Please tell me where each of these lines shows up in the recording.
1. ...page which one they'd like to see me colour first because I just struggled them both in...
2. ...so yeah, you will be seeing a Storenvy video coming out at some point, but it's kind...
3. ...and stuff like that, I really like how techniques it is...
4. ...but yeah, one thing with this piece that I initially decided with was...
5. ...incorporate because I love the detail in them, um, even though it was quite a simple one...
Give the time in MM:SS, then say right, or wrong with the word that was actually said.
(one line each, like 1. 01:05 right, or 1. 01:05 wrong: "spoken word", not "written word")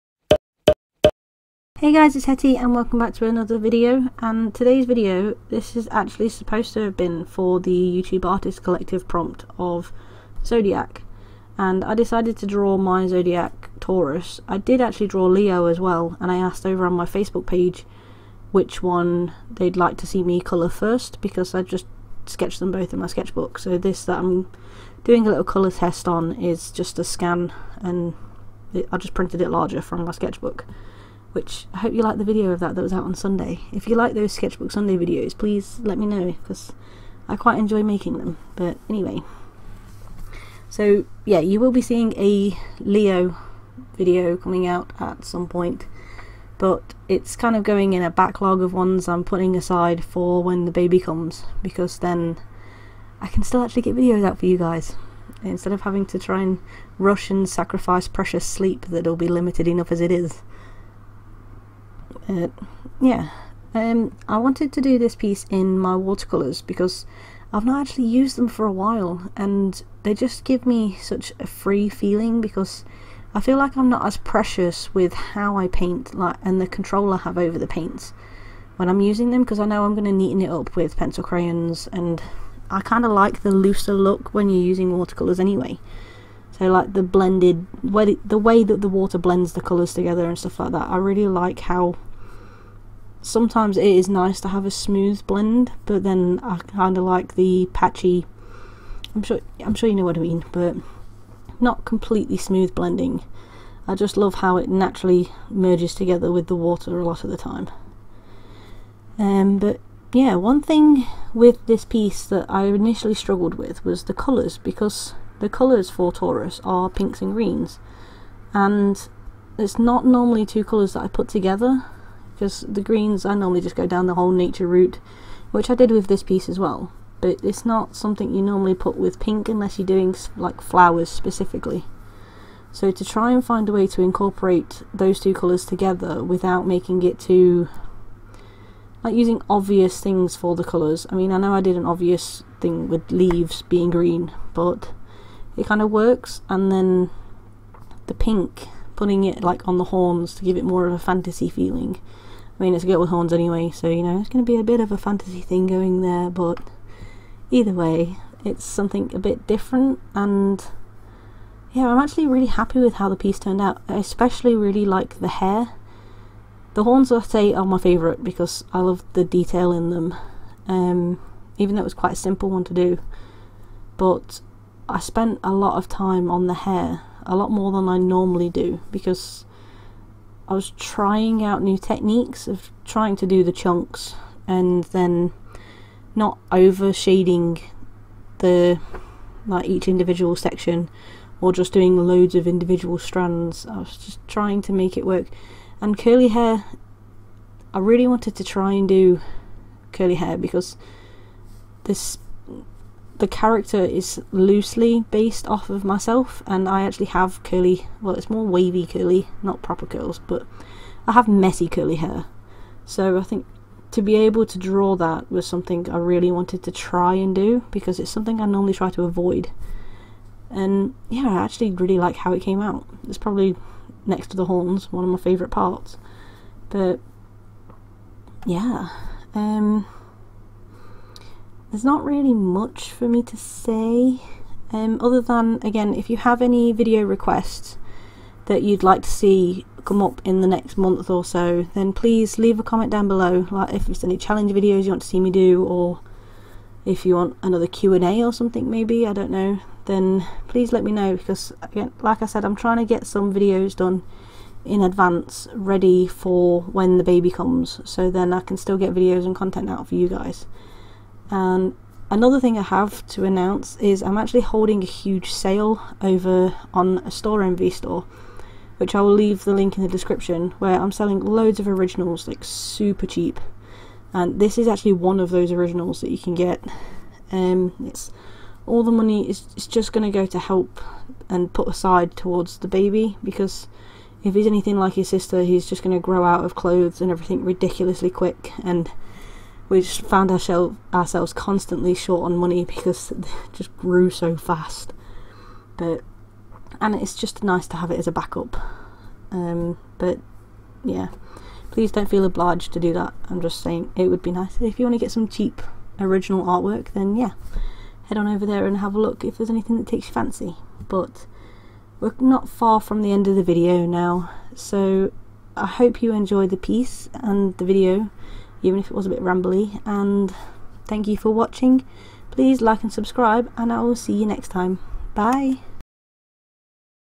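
1. 00:17 wrong: "sketched", not "struggled"
2. 00:40 wrong: "Leo", not "Storenvy"
3. 01:30 wrong: "sometimes", not "techniques"
4. 01:49 wrong: "struggled", not "decided"
5. 02:47 wrong: "favourite", not "incorporate".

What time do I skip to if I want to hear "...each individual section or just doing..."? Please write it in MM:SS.
03:09.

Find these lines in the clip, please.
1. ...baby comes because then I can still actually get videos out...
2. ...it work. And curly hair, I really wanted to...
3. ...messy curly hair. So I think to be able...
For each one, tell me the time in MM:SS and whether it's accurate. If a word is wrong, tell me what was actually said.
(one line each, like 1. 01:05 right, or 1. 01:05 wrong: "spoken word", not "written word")
1. 00:50 right
2. 03:14 right
3. 03:31 right.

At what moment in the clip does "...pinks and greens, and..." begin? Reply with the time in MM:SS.
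01:56.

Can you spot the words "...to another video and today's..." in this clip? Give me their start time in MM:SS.
00:03.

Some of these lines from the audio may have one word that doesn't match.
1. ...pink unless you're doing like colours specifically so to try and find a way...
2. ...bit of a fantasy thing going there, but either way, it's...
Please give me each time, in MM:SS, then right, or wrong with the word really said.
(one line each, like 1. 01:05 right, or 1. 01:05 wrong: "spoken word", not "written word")
1. 02:09 wrong: "flowers", not "colours"
2. 02:34 right.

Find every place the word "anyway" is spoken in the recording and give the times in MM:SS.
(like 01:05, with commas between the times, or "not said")
00:38, 01:25, 02:33.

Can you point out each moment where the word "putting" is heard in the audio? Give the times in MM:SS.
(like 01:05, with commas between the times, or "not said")
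00:49, 02:28.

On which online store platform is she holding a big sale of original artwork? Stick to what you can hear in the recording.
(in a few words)
Storenvy.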